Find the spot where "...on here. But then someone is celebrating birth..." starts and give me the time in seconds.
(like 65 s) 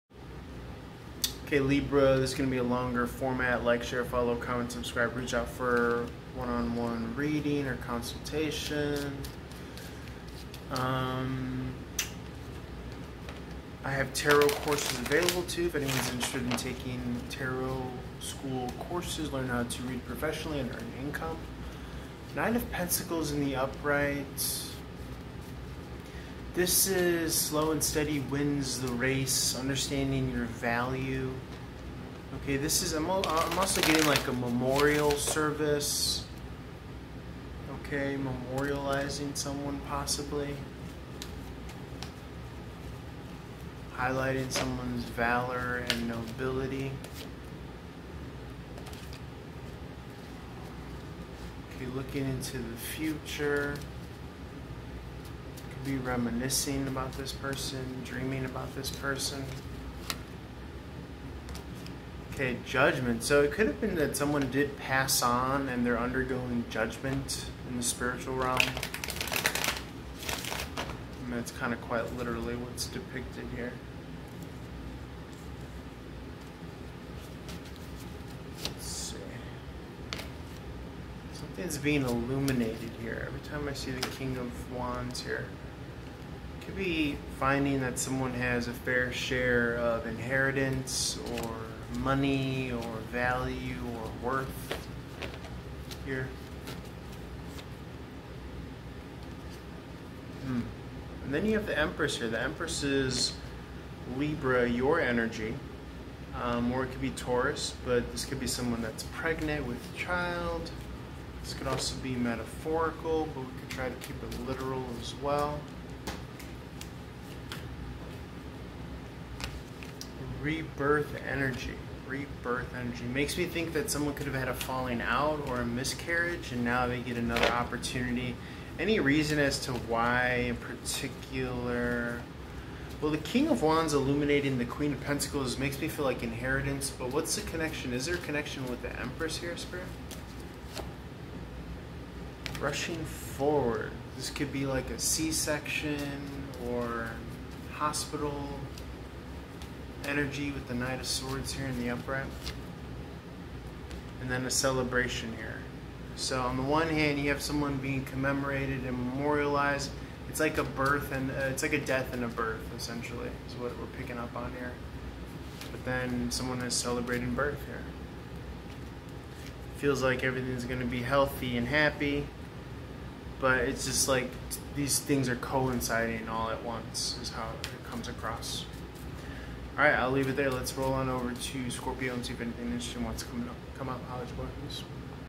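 164 s.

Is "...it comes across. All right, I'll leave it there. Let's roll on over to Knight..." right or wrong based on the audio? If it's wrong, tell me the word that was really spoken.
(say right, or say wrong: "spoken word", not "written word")
wrong: "Scorpio", not "Knight".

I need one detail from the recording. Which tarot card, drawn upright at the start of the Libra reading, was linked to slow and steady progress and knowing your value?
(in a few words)
Nine of Pentacles.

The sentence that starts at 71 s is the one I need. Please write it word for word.
that's kind of quite literally what's depicted here.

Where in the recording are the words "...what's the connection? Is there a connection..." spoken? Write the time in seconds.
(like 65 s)
137 s.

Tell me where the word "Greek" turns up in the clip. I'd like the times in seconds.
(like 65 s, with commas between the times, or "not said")
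not said.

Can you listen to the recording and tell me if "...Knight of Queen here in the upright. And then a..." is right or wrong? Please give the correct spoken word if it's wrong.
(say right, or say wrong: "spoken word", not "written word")
wrong: "Swords", not "Queen".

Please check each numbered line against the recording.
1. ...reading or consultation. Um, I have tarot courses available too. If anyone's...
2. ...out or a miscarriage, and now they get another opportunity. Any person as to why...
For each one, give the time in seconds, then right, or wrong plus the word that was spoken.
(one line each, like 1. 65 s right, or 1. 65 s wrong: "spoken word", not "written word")
1. 7 s right
2. 125 s wrong: "reason", not "person".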